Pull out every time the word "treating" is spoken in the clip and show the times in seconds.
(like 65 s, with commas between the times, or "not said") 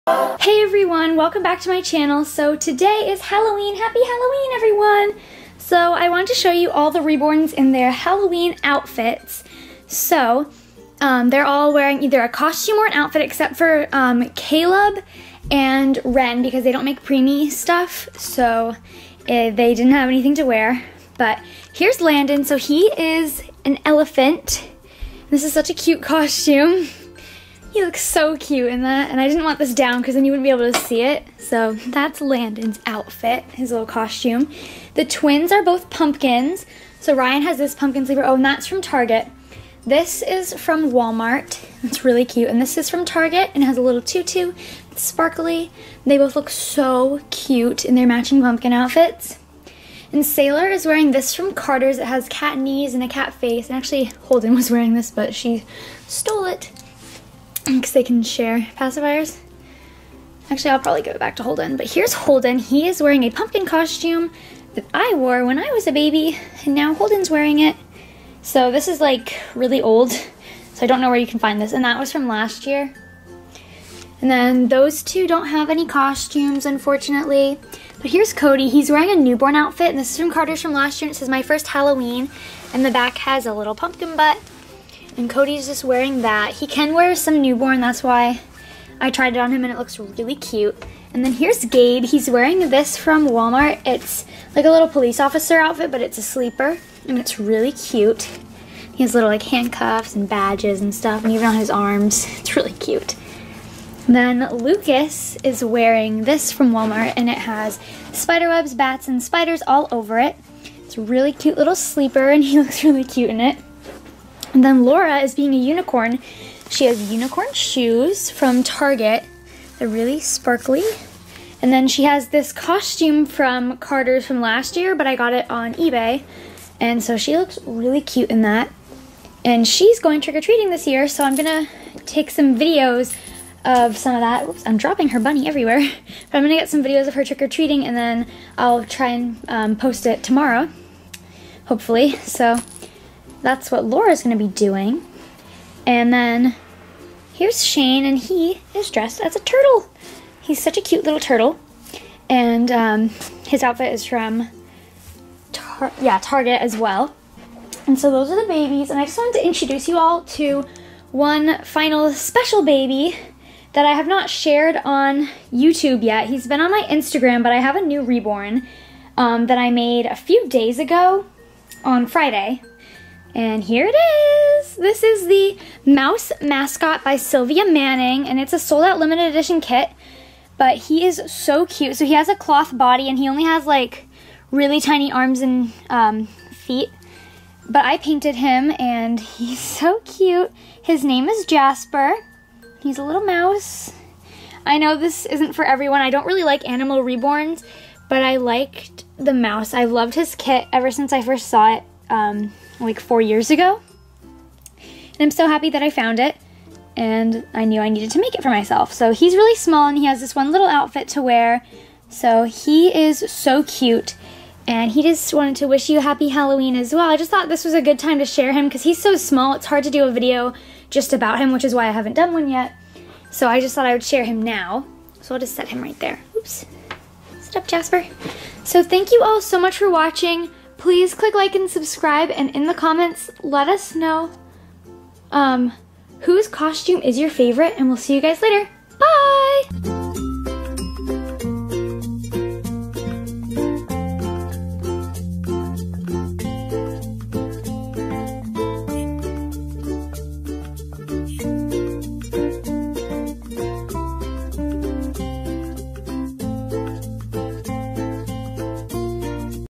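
130 s, 137 s.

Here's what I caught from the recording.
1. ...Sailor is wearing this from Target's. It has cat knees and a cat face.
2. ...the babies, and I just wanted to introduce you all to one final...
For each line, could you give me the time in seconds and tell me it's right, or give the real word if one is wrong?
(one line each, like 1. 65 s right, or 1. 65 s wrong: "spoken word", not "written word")
1. 50 s wrong: "Carter", not "Target"
2. 158 s right.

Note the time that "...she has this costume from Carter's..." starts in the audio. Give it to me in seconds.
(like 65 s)
121 s.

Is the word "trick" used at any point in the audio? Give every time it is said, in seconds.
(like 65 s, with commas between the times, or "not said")
130 s, 137 s.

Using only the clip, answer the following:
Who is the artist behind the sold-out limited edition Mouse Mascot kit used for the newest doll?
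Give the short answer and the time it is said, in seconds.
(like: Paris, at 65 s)
Sylvia Manning, at 177 s.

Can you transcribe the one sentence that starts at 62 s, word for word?
He is wearing a pumpkin costume that I wore when I was a baby, and now Holden's wearing it.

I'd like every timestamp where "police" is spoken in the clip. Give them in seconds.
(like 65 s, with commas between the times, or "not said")
94 s.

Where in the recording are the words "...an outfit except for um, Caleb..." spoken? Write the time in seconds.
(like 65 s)
12 s.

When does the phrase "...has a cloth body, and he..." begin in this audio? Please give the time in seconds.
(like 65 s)
182 s.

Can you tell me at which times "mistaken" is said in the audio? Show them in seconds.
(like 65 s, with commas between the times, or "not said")
not said.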